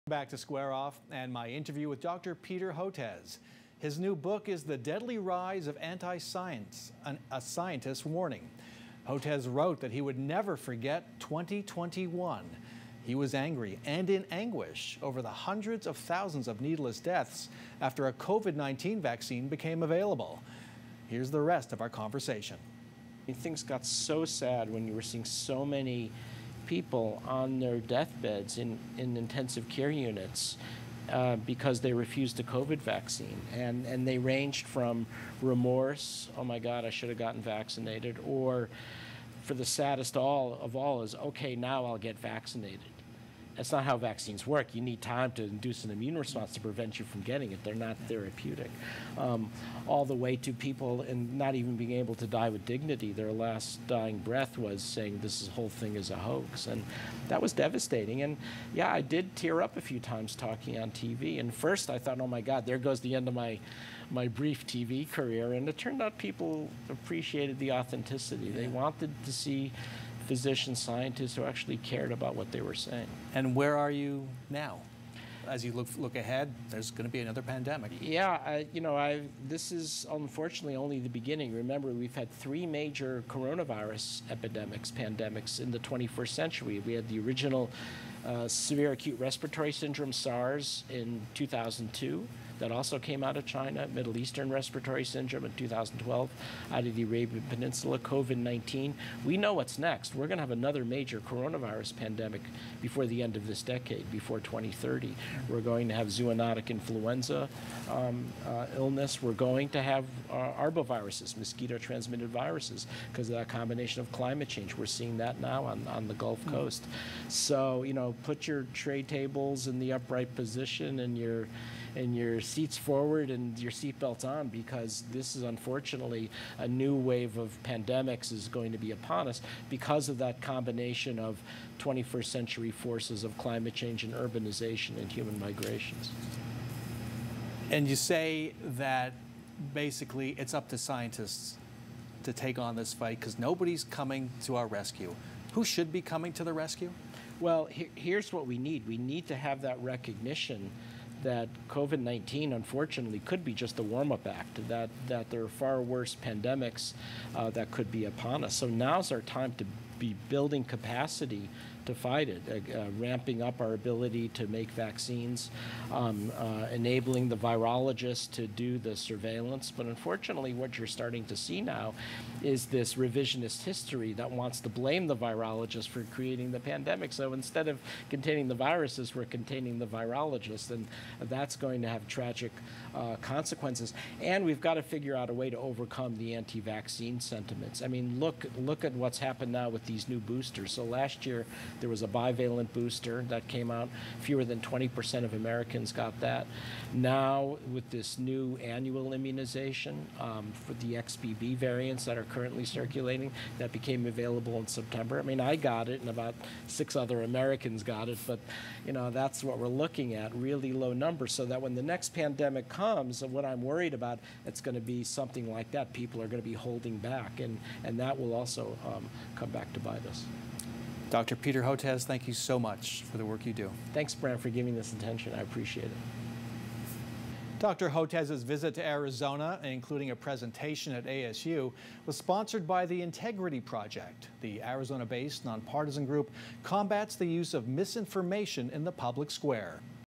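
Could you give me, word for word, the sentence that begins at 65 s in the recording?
And it turned out people appreciated the authenticity.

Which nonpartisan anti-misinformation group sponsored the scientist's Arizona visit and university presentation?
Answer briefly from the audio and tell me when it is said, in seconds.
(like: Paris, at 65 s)
The Integrity Project, at 233 s.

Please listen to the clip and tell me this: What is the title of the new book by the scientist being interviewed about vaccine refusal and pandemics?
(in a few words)
The Deadly Rise of Anti Science.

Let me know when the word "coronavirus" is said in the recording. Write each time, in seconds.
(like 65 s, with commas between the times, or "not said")
83 s, 101 s.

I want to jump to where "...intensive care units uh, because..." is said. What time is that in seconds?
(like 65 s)
29 s.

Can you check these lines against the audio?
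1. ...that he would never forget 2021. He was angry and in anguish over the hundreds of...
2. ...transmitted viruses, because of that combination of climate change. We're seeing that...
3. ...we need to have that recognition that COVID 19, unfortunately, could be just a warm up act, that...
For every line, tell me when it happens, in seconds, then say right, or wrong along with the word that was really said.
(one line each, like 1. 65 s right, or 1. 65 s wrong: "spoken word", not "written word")
1. 9 s right
2. 111 s right
3. 148 s right.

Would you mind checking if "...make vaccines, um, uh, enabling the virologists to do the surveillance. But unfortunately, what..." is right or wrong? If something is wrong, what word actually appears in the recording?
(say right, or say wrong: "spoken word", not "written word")
right.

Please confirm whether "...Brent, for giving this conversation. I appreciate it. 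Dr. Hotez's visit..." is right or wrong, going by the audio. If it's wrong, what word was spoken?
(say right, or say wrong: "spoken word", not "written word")
wrong: "attention", not "conversation".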